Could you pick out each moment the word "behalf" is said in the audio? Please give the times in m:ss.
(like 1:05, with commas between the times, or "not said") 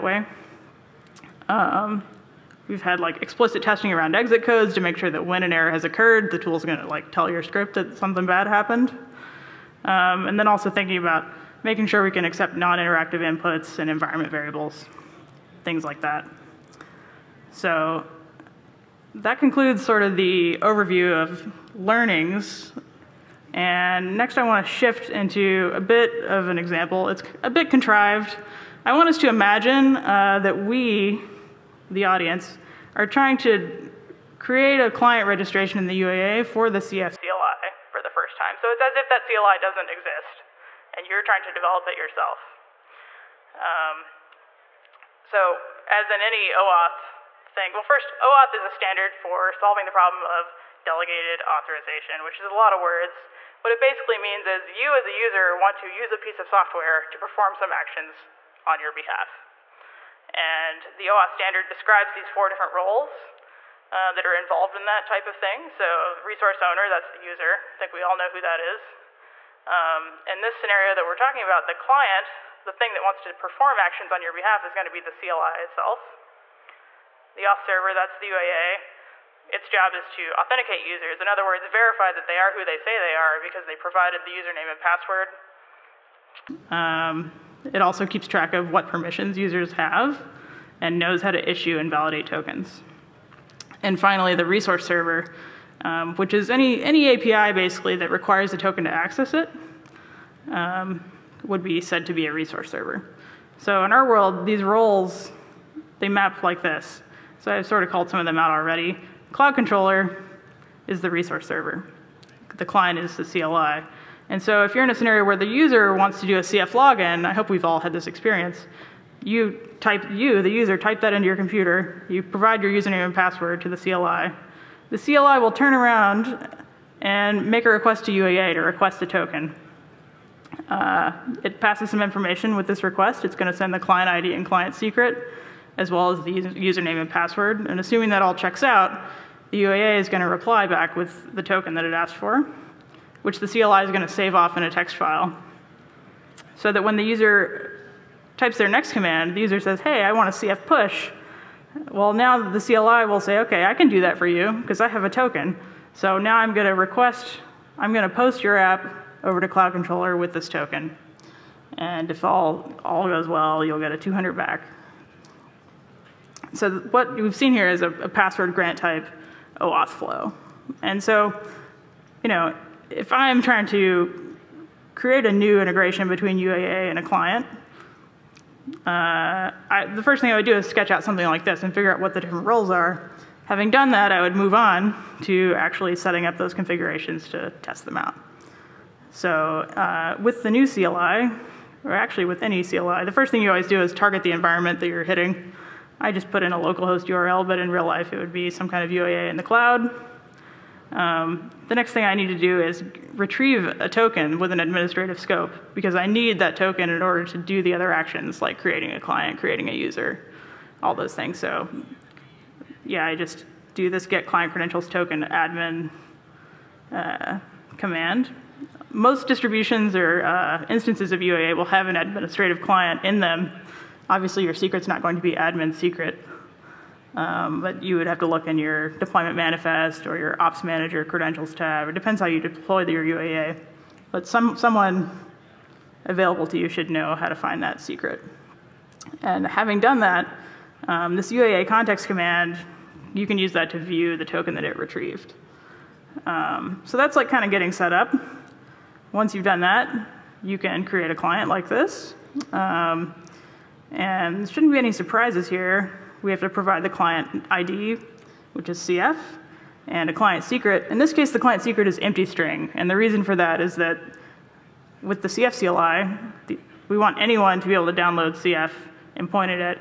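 0:58, 1:14.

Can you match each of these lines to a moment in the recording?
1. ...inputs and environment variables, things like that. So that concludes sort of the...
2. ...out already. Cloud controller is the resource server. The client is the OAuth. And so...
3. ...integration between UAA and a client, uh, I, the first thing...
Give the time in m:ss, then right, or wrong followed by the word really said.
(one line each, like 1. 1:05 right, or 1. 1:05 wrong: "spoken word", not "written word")
1. 0:13 right
2. 1:48 wrong: "CLI", not "OAuth"
3. 2:55 right.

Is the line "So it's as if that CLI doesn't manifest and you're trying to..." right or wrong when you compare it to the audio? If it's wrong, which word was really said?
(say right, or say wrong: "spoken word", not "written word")
wrong: "exist", not "manifest".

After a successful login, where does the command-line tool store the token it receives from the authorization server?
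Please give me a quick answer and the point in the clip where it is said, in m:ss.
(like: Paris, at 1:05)
In a text file, at 2:24.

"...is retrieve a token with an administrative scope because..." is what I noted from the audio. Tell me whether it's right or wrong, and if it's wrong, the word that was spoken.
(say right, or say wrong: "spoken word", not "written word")
right.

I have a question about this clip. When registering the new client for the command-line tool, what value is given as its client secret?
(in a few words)
Empty string.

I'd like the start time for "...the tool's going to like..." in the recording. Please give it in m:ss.
0:06.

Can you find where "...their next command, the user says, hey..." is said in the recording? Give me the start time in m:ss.
2:28.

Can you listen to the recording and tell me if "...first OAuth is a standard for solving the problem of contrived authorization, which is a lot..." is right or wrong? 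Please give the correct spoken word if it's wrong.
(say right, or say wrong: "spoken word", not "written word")
wrong: "delegated", not "contrived".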